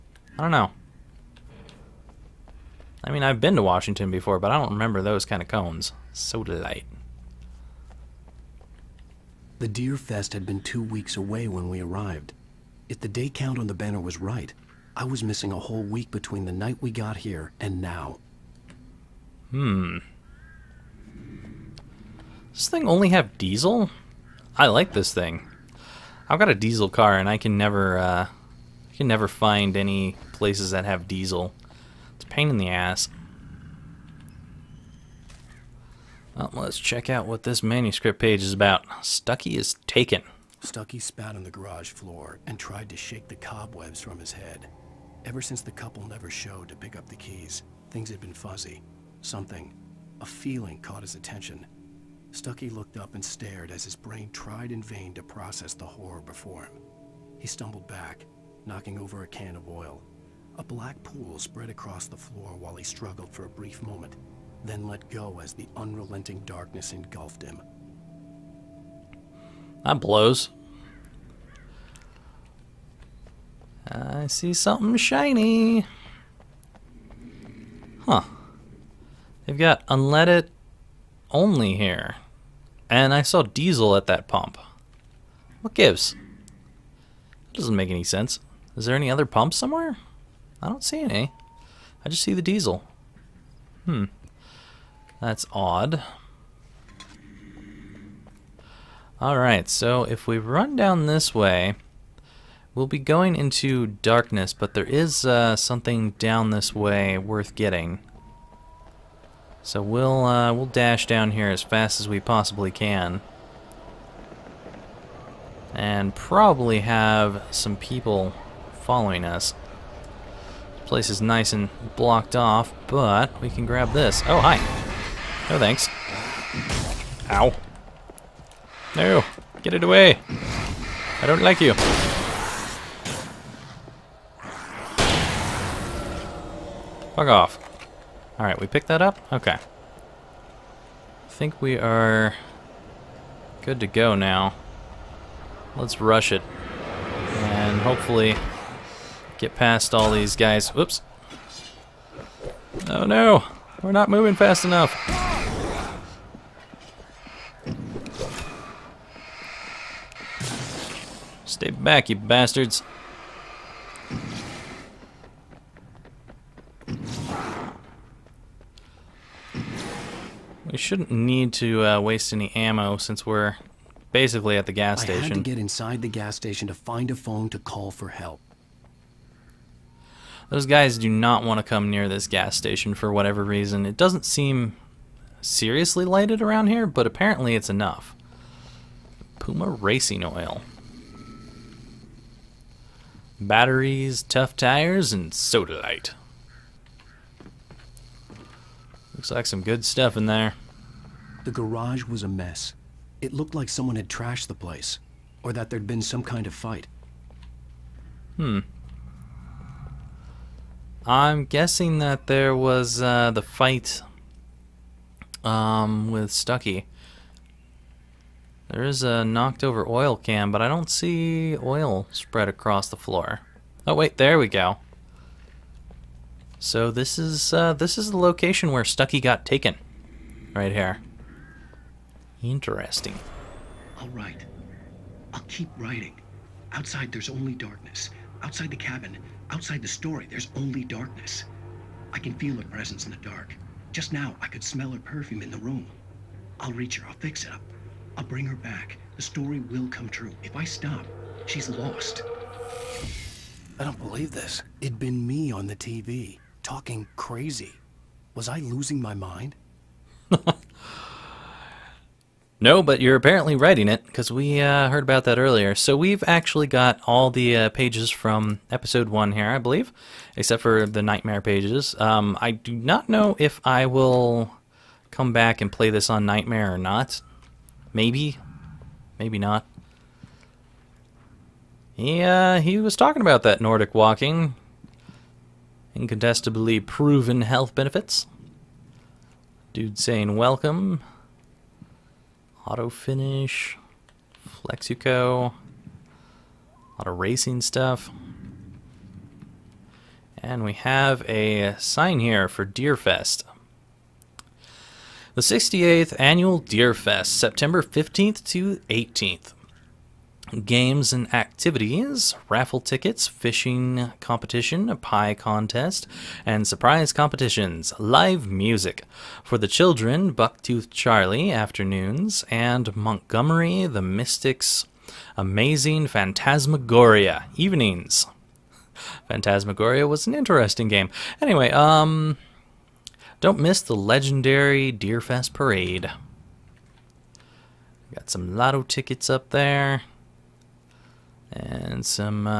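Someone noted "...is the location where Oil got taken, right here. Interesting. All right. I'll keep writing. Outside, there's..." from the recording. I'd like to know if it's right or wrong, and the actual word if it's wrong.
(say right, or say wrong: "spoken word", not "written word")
wrong: "Stucky", not "Oil".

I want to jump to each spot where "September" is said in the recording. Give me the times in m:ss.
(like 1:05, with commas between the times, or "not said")
5:07.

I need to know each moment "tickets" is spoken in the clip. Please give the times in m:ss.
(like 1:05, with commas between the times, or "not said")
5:12, 5:38.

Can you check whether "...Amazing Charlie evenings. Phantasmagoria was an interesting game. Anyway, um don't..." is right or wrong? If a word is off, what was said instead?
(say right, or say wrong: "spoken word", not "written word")
wrong: "Phantasmagoria", not "Charlie".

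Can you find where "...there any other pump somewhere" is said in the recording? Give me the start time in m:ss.
1:28.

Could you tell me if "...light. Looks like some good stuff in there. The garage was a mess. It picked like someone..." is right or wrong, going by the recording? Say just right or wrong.
wrong.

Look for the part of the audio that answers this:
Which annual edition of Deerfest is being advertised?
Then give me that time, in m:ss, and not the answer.
5:05.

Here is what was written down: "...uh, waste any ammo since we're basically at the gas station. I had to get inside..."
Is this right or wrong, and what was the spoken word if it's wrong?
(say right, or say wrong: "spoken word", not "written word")
right.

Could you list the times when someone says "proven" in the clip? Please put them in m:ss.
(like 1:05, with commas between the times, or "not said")
4:46.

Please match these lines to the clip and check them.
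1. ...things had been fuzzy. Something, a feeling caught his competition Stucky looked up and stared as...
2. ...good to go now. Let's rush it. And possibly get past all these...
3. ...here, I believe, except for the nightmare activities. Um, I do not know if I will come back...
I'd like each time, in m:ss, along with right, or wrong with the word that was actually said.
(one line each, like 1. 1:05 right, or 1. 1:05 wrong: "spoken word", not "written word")
1. 0:47 wrong: "attention", not "competition"
2. 2:23 wrong: "hopefully", not "possibly"
3. 4:29 wrong: "pages", not "activities".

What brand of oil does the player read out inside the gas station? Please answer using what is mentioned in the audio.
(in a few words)
Puma Racing Oil.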